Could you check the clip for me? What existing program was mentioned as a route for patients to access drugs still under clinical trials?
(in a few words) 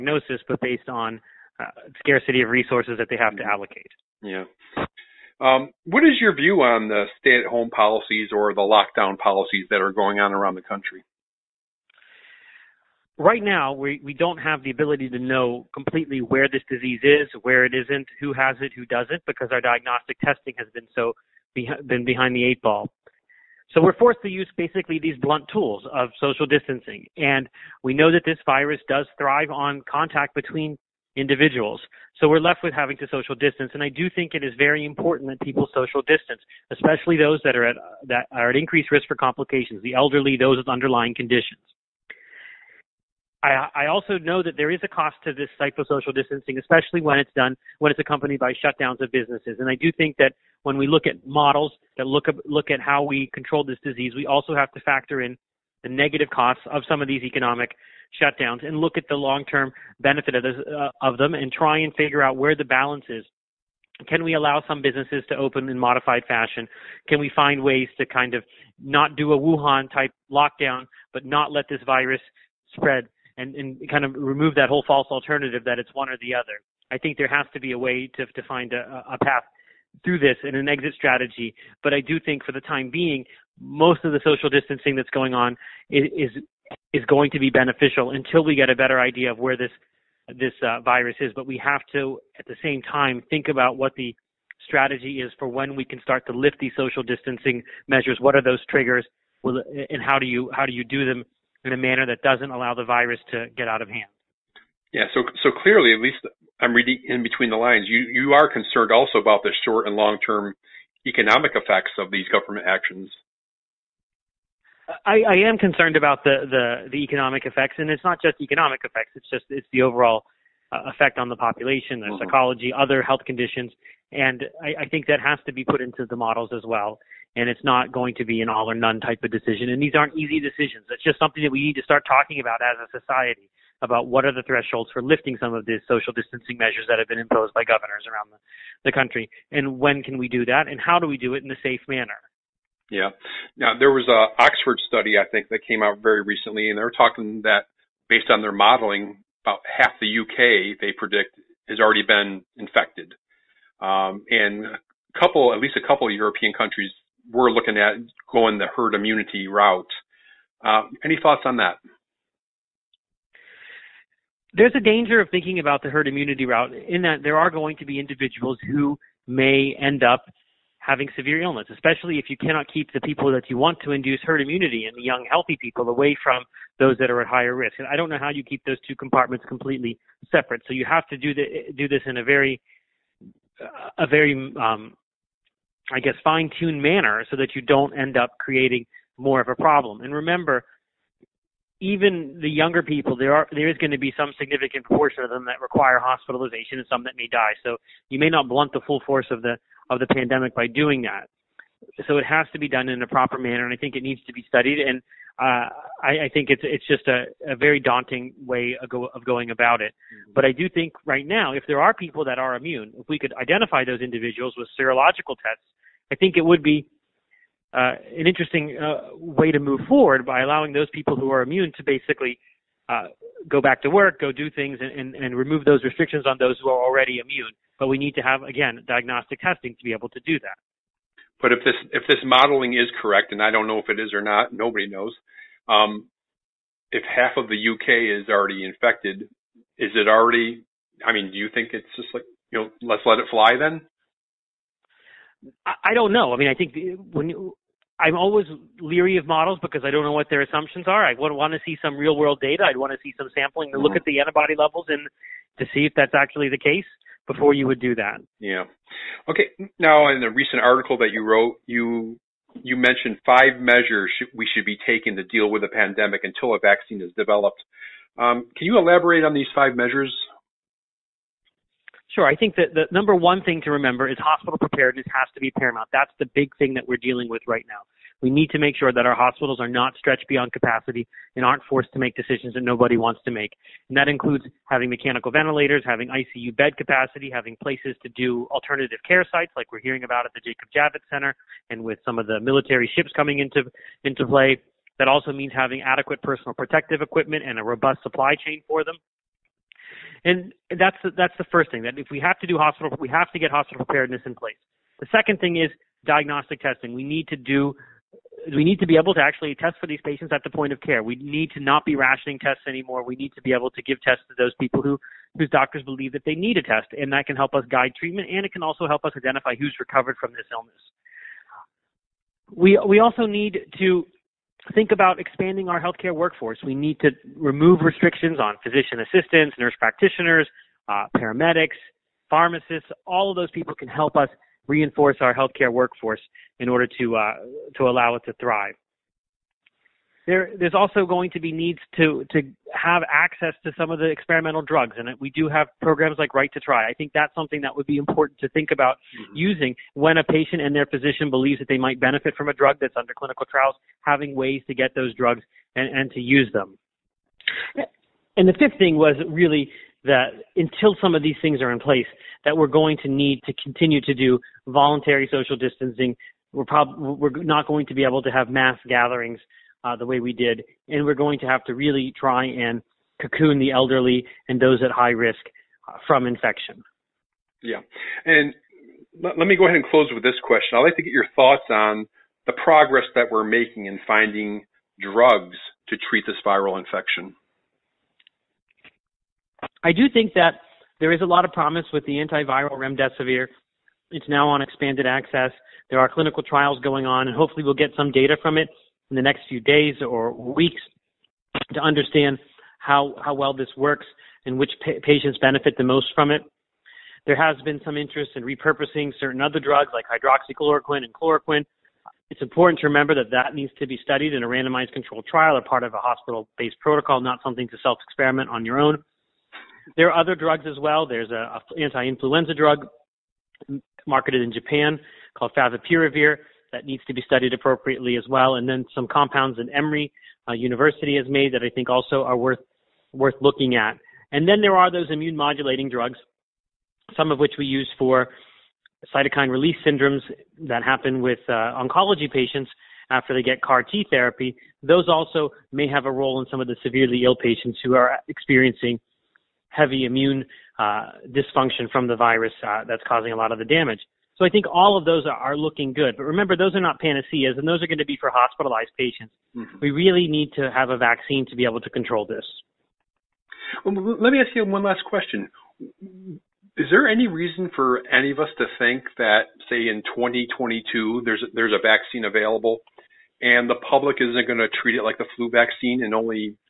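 Right to Try.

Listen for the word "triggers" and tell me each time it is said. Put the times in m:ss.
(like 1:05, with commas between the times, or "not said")
1:38.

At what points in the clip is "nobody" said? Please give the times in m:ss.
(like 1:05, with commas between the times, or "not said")
3:54, 4:42.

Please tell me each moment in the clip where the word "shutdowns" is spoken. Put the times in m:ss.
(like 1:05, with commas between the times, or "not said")
0:48, 0:58.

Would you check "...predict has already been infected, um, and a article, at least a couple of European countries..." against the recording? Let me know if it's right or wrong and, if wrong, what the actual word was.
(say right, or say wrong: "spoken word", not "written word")
wrong: "couple", not "article".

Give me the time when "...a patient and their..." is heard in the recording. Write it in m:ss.
5:50.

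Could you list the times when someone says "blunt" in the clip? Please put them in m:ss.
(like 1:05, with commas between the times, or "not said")
0:25, 3:18.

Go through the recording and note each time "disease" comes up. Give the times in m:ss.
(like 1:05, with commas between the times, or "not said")
0:16, 0:53.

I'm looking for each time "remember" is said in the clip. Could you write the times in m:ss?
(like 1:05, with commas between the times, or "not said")
3:10, 4:33, 6:52, 7:36.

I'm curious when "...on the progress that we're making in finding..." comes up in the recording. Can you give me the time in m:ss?
6:21.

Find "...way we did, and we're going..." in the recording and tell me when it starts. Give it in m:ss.
6:10.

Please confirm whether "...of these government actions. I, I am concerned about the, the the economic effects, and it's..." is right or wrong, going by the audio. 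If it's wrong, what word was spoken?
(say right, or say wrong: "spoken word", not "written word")
right.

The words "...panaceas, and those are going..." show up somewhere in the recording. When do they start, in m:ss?
7:36.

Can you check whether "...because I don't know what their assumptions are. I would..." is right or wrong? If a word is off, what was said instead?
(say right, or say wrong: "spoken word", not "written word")
right.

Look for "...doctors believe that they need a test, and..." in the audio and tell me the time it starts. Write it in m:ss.
5:15.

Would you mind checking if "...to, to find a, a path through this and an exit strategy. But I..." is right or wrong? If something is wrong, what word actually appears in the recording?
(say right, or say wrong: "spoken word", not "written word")
right.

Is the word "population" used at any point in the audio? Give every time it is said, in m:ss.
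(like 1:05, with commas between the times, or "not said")
2:01.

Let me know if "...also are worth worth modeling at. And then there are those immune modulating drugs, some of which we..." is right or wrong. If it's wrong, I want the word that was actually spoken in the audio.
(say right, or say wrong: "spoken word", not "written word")
wrong: "looking", not "modeling".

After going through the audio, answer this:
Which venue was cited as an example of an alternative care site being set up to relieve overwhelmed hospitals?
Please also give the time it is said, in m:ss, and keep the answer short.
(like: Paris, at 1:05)
Jacob Javits Center, at 4:50.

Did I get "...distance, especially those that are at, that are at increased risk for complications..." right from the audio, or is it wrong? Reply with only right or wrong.
right.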